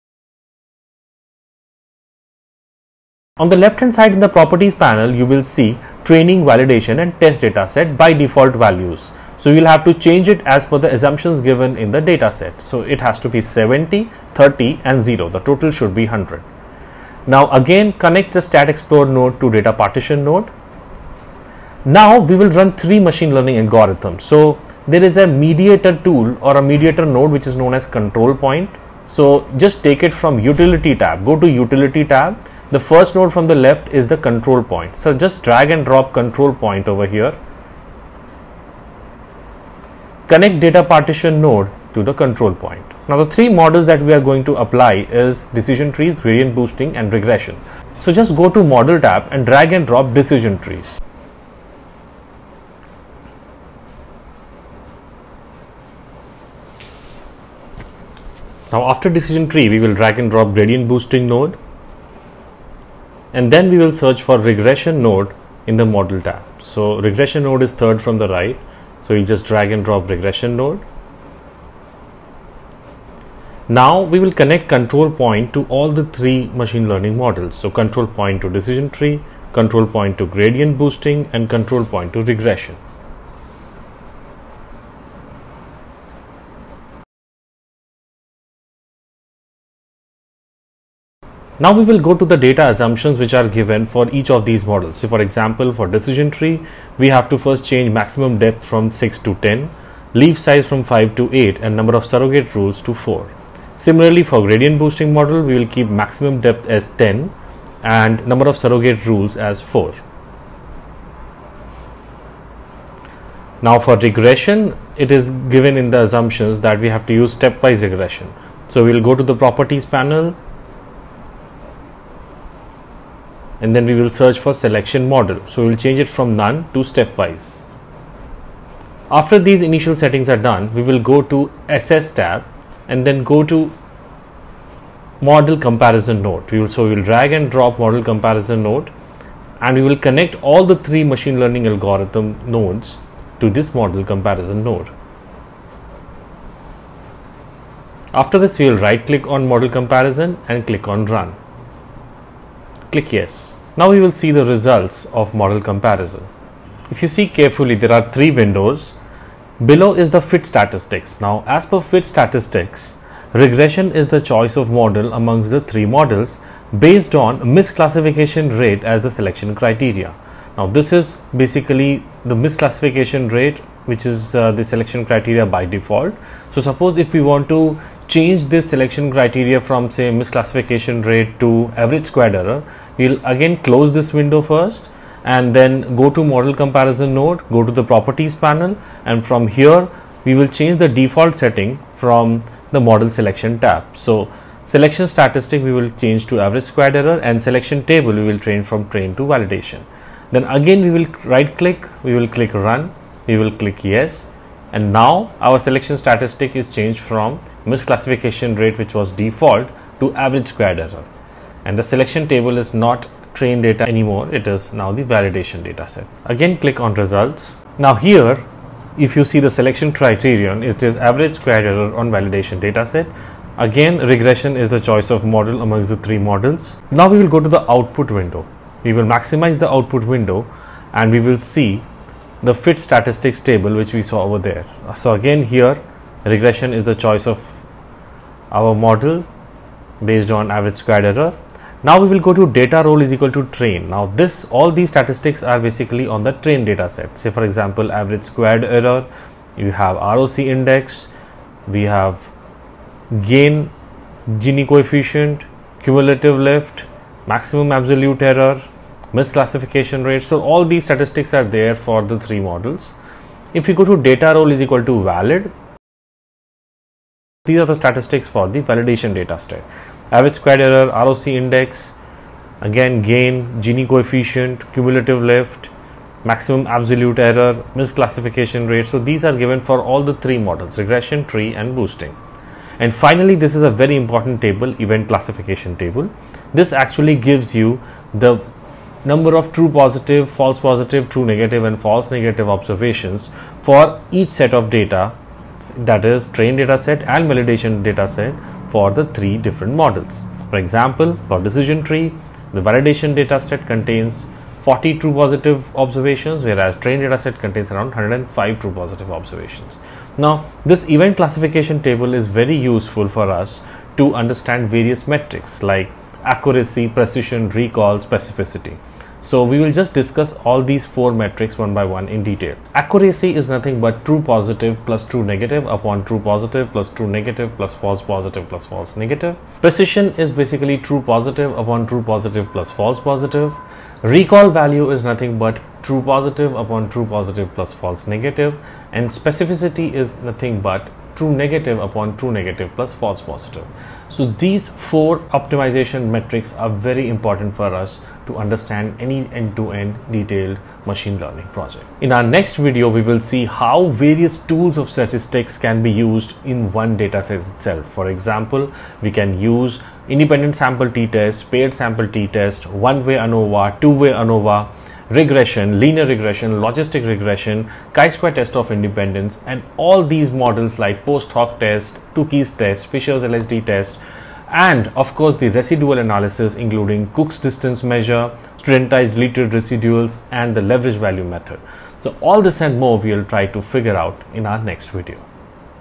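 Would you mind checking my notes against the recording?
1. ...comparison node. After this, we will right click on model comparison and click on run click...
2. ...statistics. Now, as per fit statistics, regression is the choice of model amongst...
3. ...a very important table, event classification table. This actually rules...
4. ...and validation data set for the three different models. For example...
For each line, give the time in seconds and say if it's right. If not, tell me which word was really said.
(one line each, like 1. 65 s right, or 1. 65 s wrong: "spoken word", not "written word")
1. 144 s right
2. 160 s right
3. 283 s wrong: "gives", not "rules"
4. 297 s right.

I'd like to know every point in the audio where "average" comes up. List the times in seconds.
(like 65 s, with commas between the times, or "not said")
181 s, 196 s, 210 s, 220 s, 240 s, 247 s, 270 s.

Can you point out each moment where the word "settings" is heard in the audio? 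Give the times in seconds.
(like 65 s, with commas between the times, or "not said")
129 s, 191 s.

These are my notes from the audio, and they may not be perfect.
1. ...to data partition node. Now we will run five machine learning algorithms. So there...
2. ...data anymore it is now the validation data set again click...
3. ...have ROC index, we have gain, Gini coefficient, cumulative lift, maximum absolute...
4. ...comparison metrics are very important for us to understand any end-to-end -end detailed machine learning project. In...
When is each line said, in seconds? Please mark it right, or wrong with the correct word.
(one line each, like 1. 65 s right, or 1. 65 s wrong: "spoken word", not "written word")
1. 19 s wrong: "three", not "five"
2. 213 s right
3. 249 s right
4. 345 s wrong: "optimization", not "comparison".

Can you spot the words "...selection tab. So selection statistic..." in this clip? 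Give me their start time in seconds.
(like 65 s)
193 s.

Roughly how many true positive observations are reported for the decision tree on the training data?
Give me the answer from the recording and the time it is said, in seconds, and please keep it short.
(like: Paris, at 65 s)
105, at 307 s.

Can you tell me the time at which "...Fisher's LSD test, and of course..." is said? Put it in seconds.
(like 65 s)
372 s.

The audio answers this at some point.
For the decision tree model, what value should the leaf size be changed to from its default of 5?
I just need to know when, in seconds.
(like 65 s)
100 s.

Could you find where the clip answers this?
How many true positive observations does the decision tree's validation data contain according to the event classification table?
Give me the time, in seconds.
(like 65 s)
304 s.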